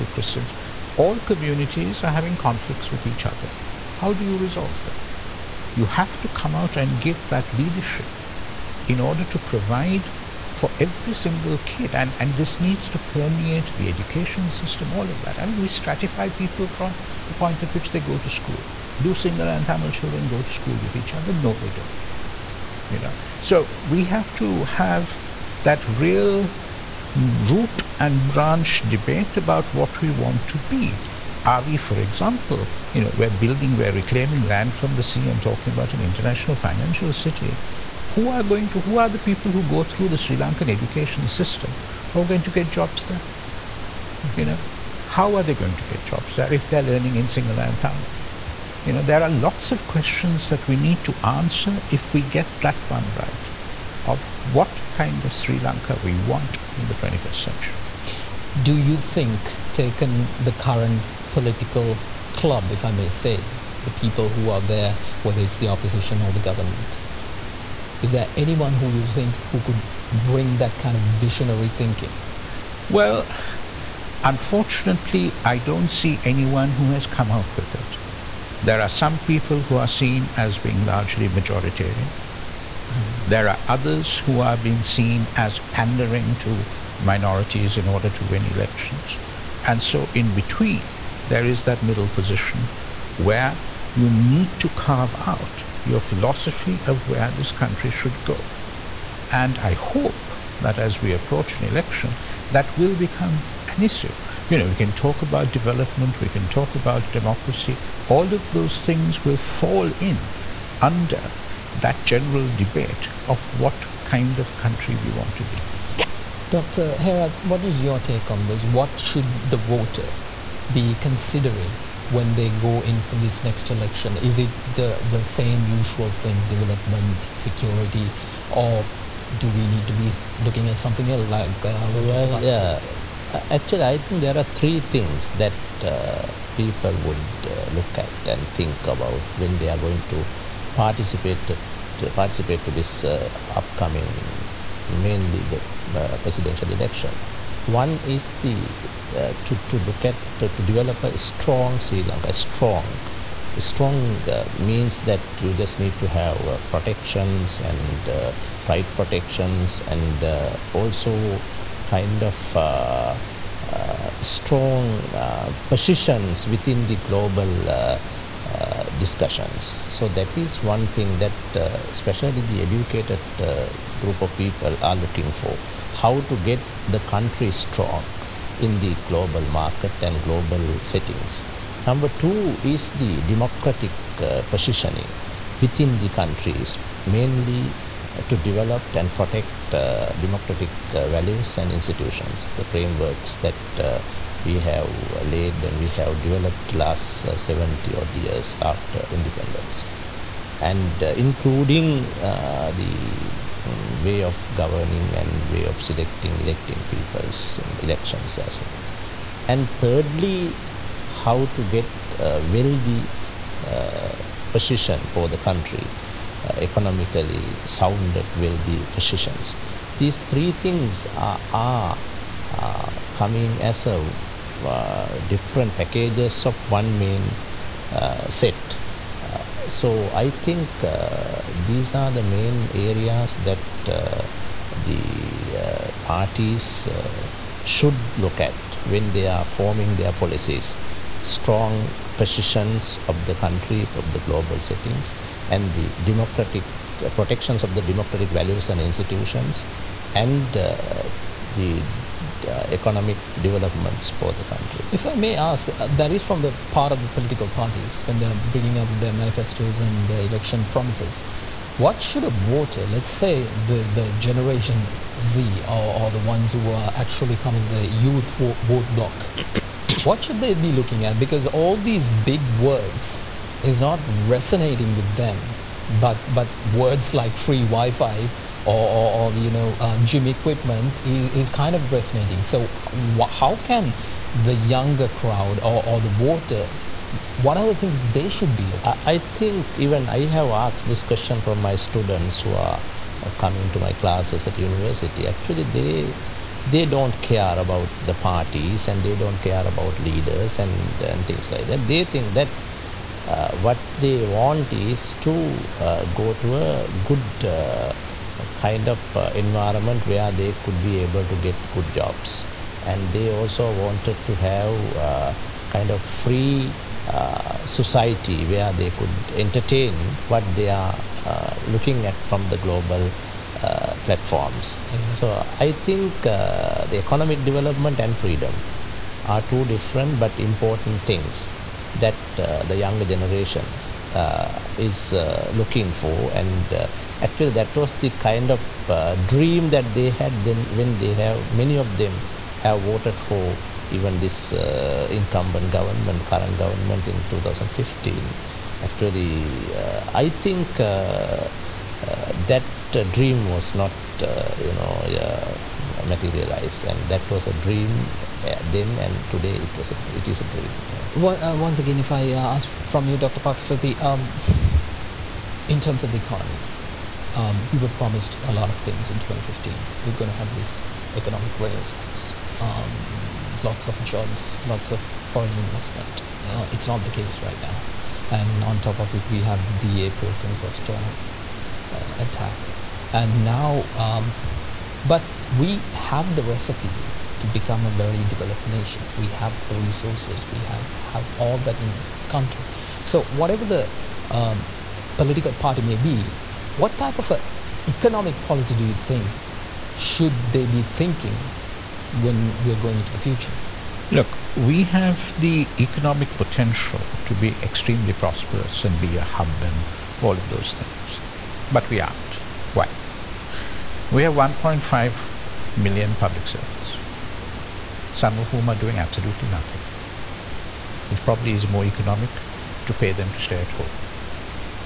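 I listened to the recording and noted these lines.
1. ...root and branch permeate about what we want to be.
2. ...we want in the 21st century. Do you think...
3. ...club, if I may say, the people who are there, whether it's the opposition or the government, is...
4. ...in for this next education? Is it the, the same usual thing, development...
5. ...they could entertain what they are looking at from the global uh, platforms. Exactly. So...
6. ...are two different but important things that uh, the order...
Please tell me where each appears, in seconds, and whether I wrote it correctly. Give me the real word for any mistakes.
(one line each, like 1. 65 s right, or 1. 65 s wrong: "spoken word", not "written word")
1. 27 s wrong: "debate", not "permeate"
2. 56 s right
3. 62 s right
4. 122 s wrong: "election", not "education"
5. 318 s right
6. 329 s wrong: "younger", not "order".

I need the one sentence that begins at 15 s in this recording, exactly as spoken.
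I mean, we stratify people from the point at which they go to school.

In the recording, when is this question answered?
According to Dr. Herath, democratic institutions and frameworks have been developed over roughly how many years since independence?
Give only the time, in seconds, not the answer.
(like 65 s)
197 s.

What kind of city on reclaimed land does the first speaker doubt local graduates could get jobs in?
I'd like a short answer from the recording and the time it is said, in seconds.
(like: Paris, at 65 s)
international financial city, at 36 s.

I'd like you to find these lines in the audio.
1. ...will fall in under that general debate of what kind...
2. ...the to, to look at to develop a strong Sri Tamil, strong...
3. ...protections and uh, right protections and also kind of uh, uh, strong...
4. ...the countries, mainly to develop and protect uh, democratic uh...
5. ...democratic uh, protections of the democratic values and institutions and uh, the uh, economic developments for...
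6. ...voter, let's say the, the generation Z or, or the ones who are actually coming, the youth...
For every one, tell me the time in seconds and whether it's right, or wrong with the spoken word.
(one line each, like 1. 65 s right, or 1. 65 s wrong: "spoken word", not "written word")
1. 109 s right
2. 148 s wrong: "Lanka", not "Tamil"
3. 156 s right
4. 185 s right
5. 246 s right
6. 262 s right.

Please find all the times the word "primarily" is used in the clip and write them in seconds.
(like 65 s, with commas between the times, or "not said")
not said.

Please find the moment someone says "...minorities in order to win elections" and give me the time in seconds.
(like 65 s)
86 s.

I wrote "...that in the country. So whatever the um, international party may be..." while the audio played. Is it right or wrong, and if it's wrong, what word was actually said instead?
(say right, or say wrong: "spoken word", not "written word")
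wrong: "political", not "international".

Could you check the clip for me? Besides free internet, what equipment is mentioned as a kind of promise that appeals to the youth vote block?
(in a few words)
gym equipment.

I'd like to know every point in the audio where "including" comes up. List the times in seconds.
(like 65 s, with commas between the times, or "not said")
201 s.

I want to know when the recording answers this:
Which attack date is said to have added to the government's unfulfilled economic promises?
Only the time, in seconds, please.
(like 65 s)
380 s.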